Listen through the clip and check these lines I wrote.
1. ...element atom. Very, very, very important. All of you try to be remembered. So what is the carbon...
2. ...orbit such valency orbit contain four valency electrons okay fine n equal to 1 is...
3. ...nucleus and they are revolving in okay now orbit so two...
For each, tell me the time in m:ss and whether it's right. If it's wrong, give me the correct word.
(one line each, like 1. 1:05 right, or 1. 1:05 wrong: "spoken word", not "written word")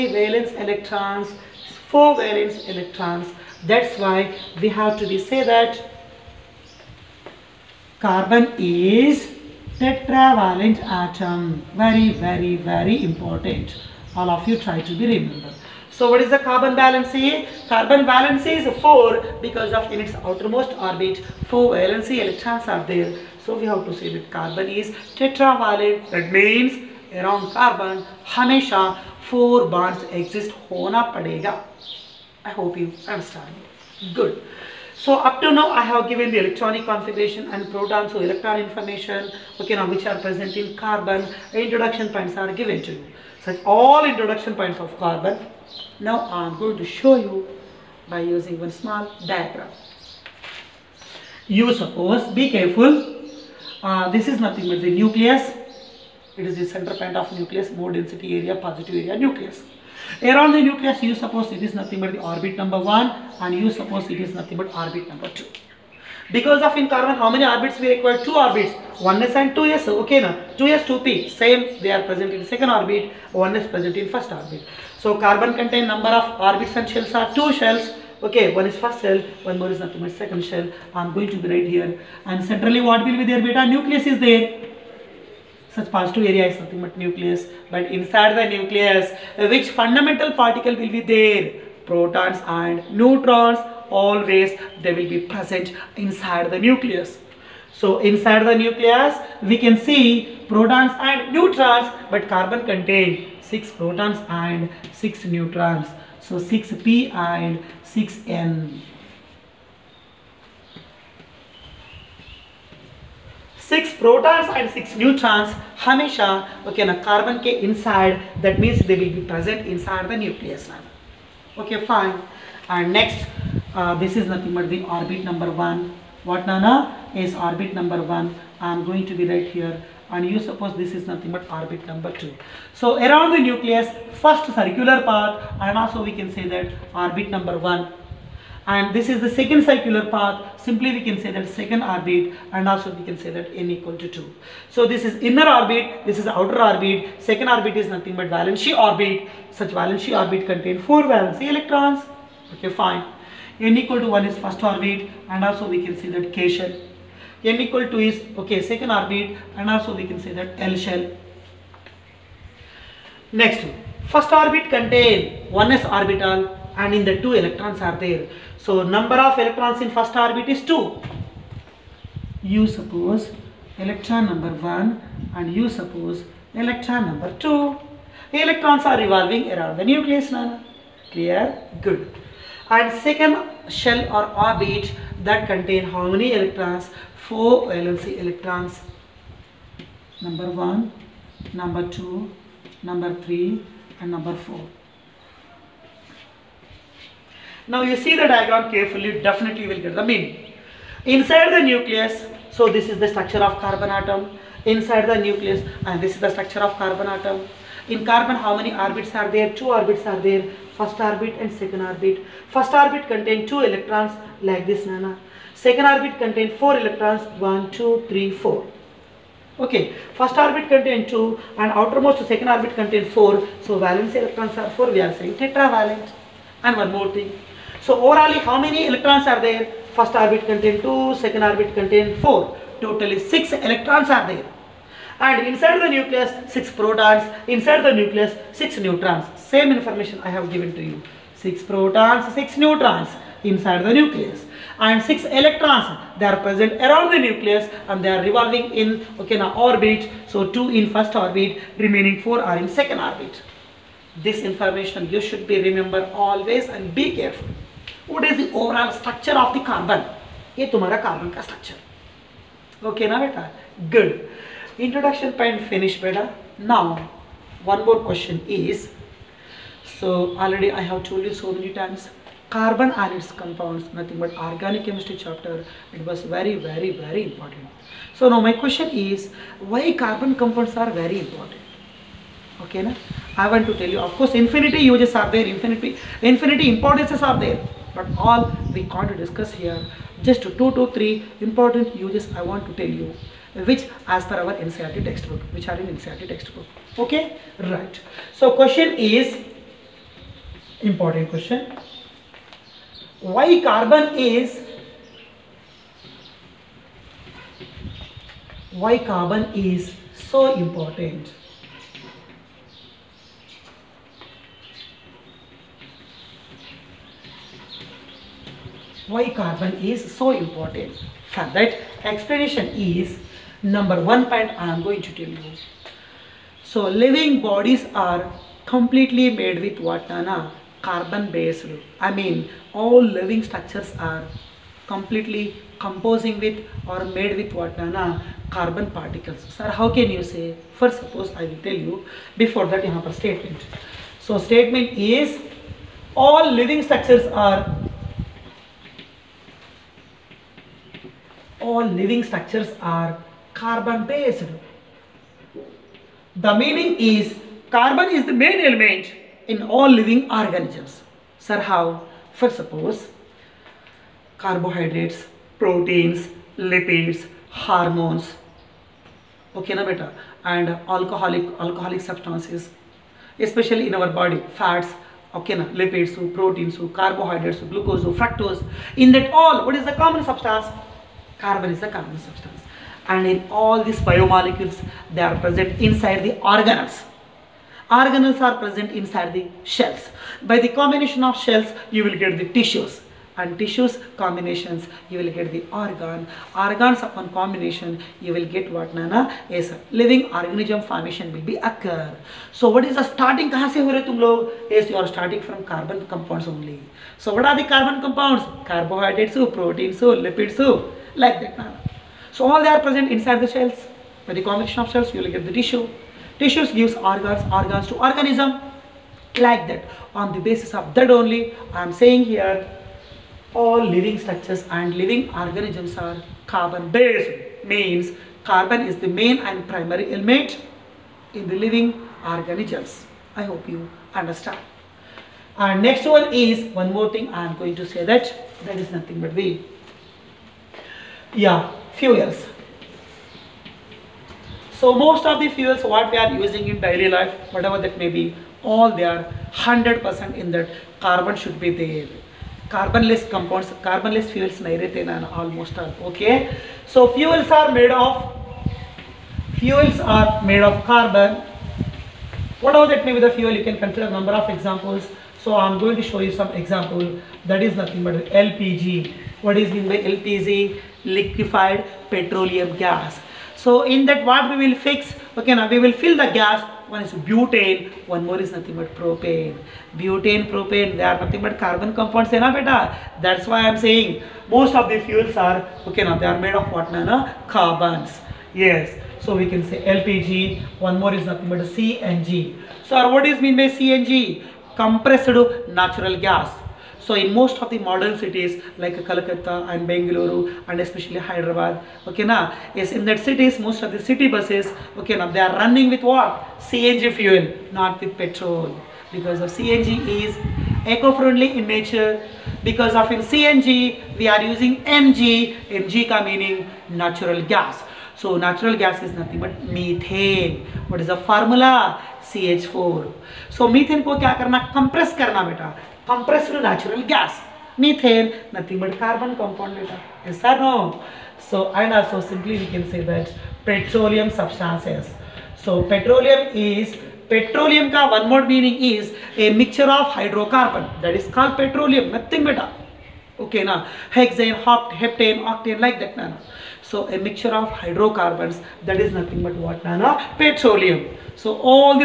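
1. 0:09 wrong: "tetravalent", not "element"
2. 2:28 right
3. 4:07 right.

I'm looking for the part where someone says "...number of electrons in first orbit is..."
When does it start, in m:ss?
2:48.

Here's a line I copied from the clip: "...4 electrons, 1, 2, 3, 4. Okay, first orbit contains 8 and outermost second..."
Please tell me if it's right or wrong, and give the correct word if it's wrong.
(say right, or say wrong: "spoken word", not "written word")
wrong: "2", not "8".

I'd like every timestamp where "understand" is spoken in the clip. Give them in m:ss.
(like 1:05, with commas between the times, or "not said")
0:33, 7:14.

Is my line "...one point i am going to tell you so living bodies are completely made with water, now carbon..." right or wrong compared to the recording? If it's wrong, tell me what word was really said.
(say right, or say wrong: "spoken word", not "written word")
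right.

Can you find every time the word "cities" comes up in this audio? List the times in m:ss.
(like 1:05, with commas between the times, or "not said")
8:18, 8:23.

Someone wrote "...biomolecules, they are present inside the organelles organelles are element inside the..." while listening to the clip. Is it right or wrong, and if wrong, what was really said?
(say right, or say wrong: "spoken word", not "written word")
wrong: "present", not "element".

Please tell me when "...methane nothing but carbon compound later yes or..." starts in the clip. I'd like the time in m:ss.
8:47.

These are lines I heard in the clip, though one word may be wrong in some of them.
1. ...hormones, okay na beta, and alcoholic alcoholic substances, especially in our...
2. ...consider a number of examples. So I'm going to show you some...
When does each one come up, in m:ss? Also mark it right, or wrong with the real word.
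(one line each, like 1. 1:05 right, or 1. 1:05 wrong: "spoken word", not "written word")
1. 6:07 right
2. 7:43 right.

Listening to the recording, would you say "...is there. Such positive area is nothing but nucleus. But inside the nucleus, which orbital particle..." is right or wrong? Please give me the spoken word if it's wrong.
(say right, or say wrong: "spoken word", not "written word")
wrong: "fundamental", not "orbital".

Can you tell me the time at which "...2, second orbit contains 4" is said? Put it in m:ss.
3:50.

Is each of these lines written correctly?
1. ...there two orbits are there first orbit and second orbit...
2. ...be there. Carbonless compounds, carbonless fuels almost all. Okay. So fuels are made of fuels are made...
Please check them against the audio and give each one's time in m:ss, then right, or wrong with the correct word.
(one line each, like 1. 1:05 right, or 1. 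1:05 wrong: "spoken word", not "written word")
1. 3:29 right
2. 7:31 right.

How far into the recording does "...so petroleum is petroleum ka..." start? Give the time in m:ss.
8:55.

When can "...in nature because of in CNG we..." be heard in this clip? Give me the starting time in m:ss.
8:31.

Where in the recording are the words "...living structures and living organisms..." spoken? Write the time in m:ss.
7:03.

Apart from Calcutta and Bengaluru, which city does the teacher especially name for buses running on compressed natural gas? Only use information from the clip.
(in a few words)
Hyderabad.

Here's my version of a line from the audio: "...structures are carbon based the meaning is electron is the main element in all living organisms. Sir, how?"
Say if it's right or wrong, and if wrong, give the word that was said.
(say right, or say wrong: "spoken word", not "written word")
wrong: "carbon", not "electron".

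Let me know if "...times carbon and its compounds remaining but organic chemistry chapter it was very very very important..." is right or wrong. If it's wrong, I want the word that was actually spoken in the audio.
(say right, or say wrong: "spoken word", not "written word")
wrong: "nothing", not "remaining".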